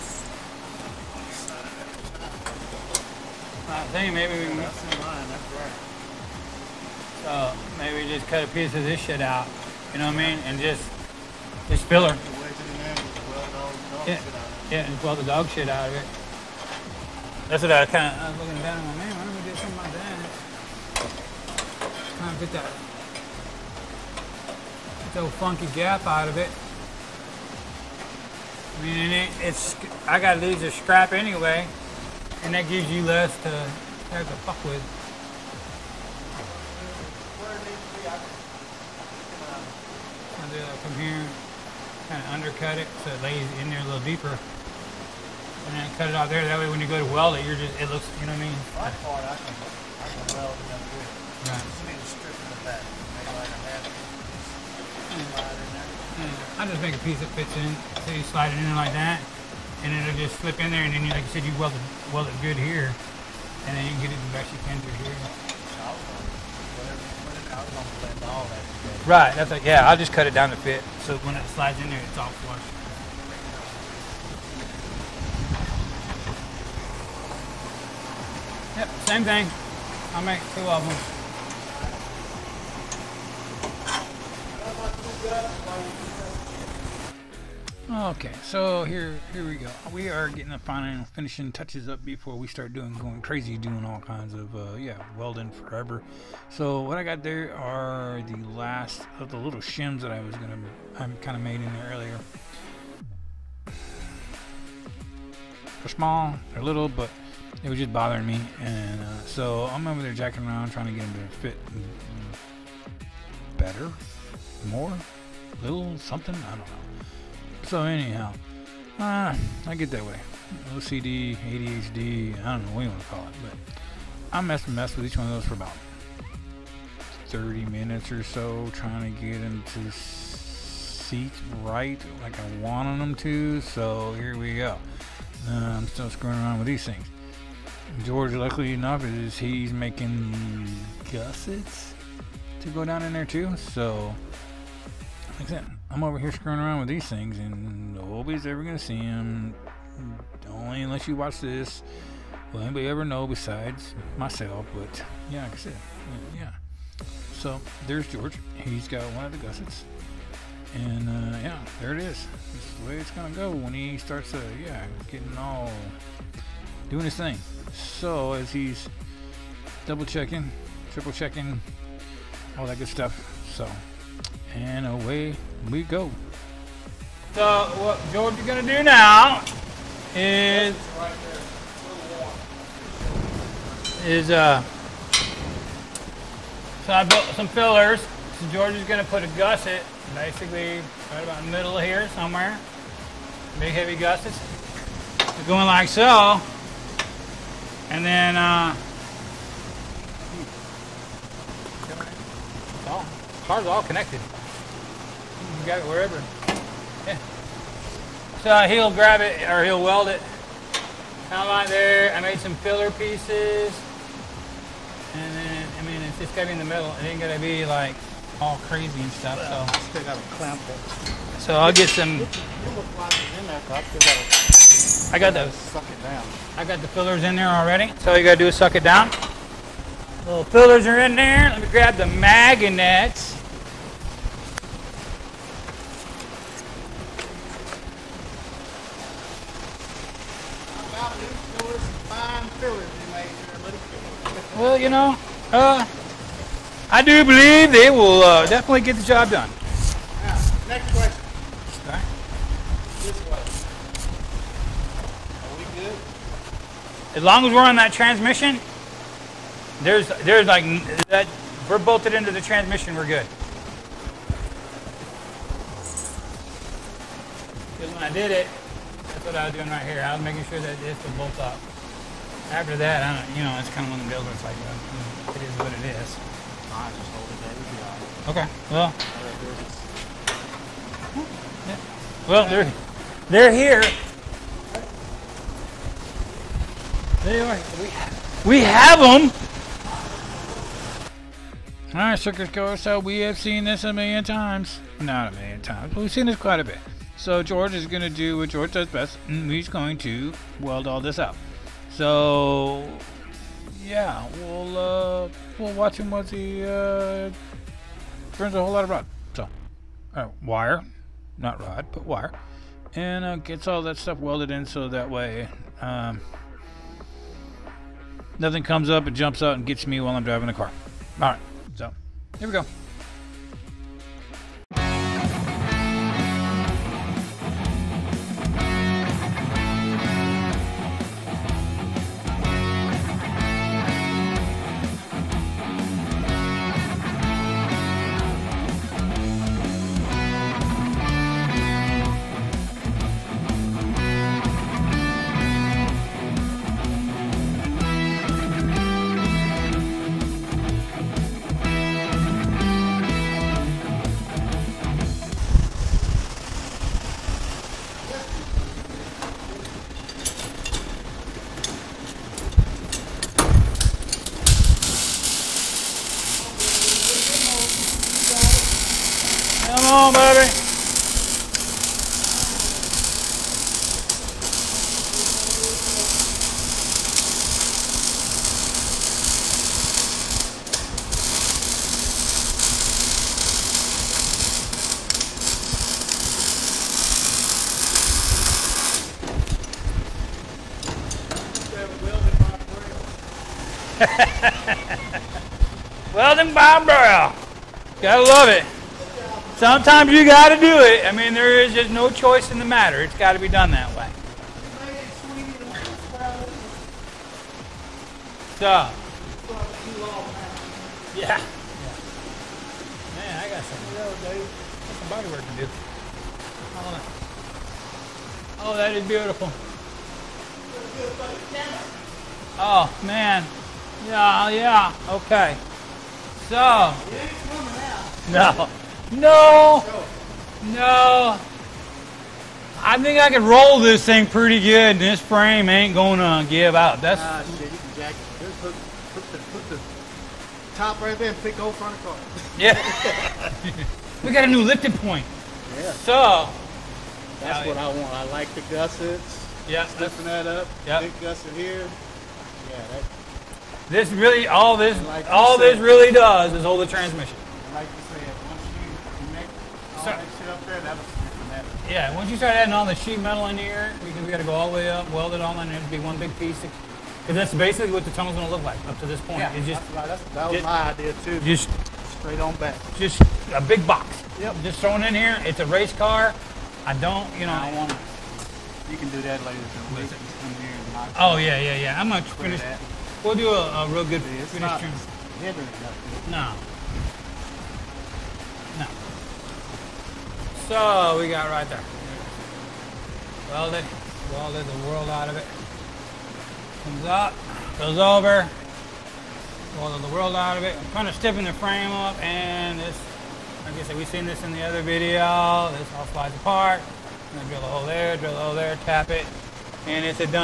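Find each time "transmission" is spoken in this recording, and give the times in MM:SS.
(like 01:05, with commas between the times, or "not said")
04:17, 04:22, 07:36.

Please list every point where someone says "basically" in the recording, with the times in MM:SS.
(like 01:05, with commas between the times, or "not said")
03:10, 07:47.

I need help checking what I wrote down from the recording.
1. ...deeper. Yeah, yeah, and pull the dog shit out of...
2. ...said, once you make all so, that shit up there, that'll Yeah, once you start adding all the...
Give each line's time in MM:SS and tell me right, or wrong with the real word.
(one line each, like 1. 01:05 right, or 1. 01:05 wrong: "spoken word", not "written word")
1. 00:11 wrong: "filler", not "deeper"
2. 07:38 right.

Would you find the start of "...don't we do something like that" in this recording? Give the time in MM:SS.
00:19.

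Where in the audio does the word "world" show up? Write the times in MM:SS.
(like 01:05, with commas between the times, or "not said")
08:14, 08:20.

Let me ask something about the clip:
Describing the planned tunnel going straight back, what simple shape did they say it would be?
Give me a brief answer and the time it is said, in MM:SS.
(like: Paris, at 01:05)
A big box, at 07:53.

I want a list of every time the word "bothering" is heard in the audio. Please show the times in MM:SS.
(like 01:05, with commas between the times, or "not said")
01:47.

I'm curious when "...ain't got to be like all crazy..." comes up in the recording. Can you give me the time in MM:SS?
03:37.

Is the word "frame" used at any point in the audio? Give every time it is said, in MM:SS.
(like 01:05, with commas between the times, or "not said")
07:15, 08:21.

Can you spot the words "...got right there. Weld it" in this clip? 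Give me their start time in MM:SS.
08:11.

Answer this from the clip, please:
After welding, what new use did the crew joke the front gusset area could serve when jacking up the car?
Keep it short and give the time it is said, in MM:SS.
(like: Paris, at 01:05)
Lifting point, at 07:24.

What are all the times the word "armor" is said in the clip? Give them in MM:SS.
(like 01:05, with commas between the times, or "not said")
not said.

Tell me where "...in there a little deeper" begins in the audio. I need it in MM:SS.
00:43.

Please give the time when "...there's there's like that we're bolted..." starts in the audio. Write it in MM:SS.
04:19.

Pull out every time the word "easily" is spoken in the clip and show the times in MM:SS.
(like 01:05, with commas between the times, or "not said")
not said.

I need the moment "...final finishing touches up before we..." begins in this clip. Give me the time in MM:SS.
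01:30.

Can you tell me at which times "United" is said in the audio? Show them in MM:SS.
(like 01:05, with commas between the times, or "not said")
not said.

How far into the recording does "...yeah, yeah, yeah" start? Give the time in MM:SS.
08:01.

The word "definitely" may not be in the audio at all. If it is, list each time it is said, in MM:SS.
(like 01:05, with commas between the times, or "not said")
04:08.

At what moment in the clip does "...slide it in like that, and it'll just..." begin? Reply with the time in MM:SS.
00:58.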